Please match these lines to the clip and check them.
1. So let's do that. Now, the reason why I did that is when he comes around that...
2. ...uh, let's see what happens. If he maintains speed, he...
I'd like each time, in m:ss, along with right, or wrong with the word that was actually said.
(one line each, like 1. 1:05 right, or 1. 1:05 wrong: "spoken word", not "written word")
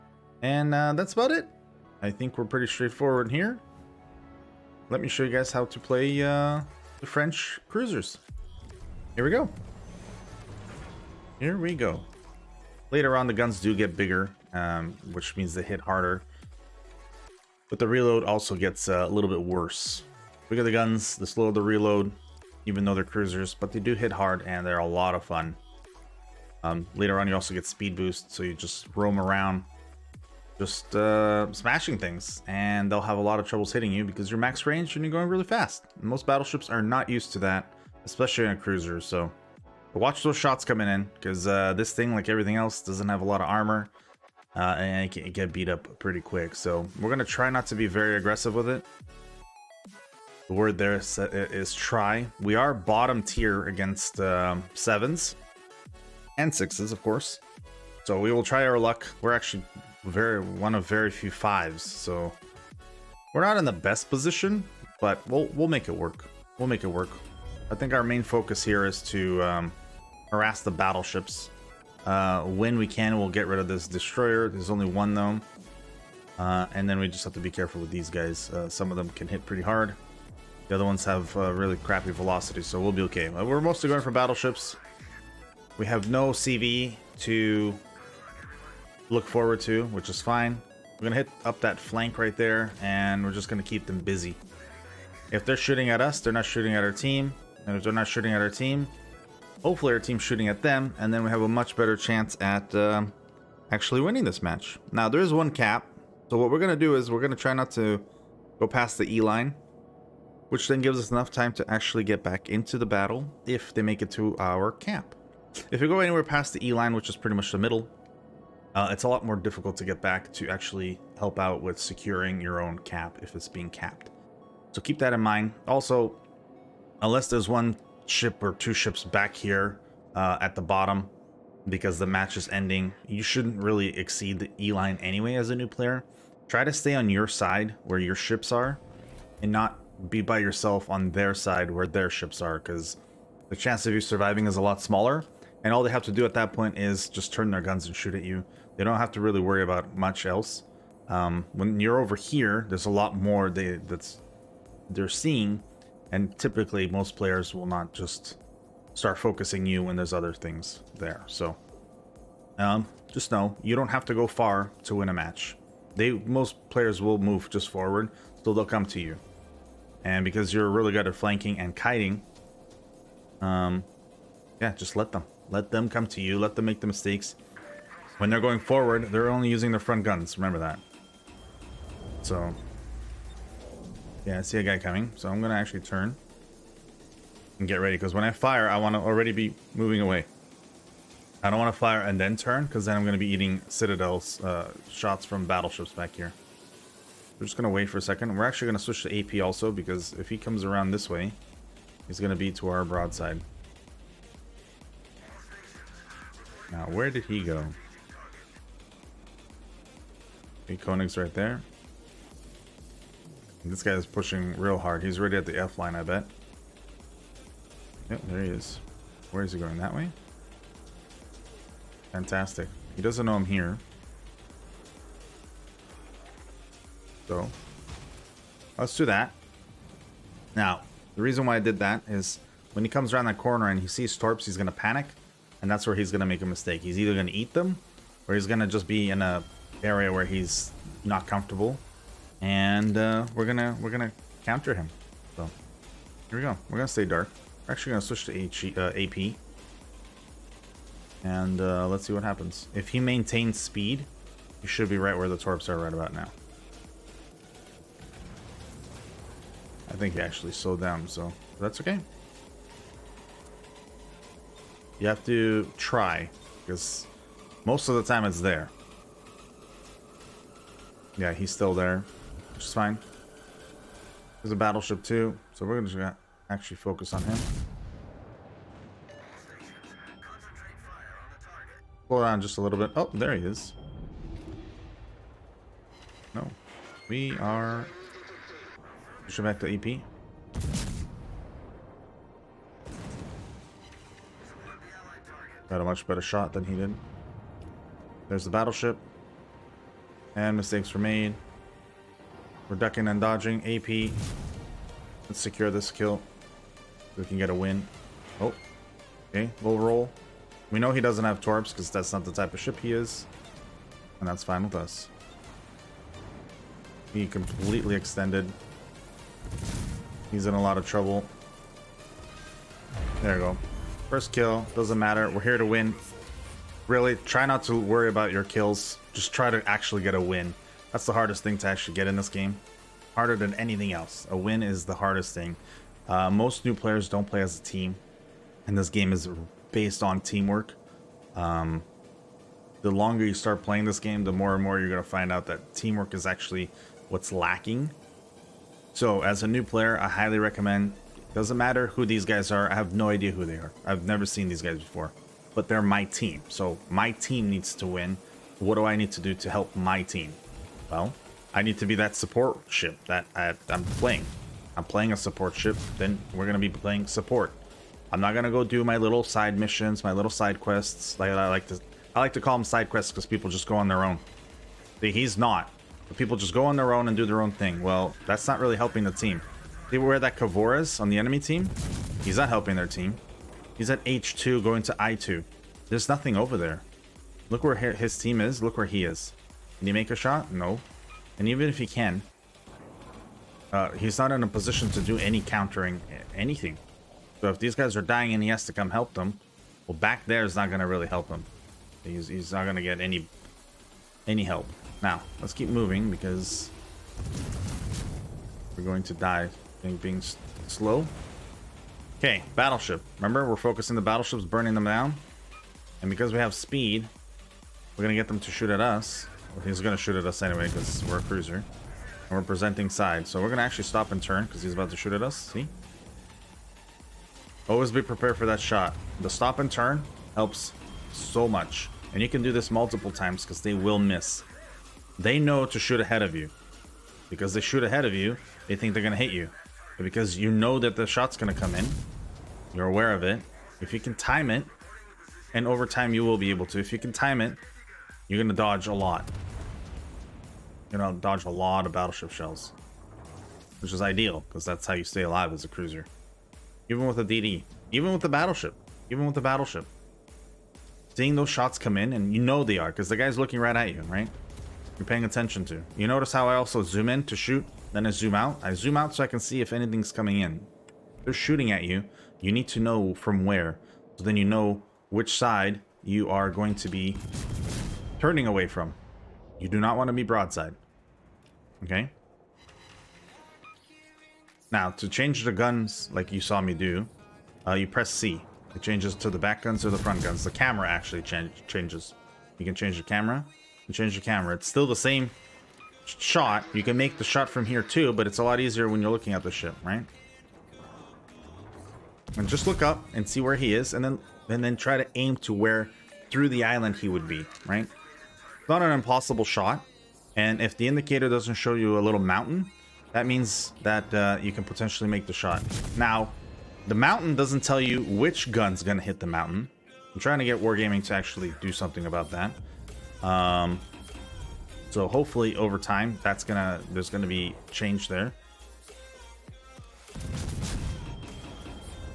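1. 3:47 right
2. 4:11 right.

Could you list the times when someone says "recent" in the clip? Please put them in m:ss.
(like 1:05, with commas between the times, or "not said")
not said.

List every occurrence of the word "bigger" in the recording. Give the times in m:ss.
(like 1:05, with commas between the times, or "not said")
0:13.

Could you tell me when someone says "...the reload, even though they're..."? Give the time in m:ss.
0:21.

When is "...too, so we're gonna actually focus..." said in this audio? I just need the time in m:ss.
4:35.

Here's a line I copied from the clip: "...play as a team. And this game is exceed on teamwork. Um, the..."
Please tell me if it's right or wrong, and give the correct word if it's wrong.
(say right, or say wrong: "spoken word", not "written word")
wrong: "based", not "exceed".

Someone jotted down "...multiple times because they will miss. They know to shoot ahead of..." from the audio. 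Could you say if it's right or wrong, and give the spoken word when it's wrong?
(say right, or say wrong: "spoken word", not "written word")
right.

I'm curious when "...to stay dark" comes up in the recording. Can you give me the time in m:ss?
4:06.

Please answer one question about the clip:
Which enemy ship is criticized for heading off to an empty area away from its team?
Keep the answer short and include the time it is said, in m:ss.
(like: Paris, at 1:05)
Kavoras, at 6:20.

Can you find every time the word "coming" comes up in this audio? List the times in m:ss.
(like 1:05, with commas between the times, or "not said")
0:40, 3:04, 7:50.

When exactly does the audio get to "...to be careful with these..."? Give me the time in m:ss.
1:17.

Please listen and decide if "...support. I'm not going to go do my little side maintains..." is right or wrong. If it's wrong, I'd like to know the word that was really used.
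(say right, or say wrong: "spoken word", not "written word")
wrong: "missions", not "maintains".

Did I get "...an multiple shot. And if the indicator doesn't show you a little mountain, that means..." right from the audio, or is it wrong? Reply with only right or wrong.
wrong.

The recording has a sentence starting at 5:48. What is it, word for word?
So as a new player, I highly recommend, doesn't matter who these guys are, I have no idea who they are.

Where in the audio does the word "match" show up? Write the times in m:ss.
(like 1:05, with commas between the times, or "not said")
1:44, 2:12, 2:45.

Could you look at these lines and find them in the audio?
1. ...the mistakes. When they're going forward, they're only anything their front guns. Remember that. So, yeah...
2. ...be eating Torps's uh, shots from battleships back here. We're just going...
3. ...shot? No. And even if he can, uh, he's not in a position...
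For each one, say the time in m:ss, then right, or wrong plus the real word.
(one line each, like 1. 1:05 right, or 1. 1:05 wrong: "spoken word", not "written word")
1. 2:56 wrong: "using", not "anything"
2. 3:13 wrong: "Citadel", not "Torps"
3. 6:30 right.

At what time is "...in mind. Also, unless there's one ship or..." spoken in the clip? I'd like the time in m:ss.
2:05.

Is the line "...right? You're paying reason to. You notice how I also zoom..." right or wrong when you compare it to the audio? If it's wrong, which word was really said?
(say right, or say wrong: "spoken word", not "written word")
wrong: "attention", not "reason".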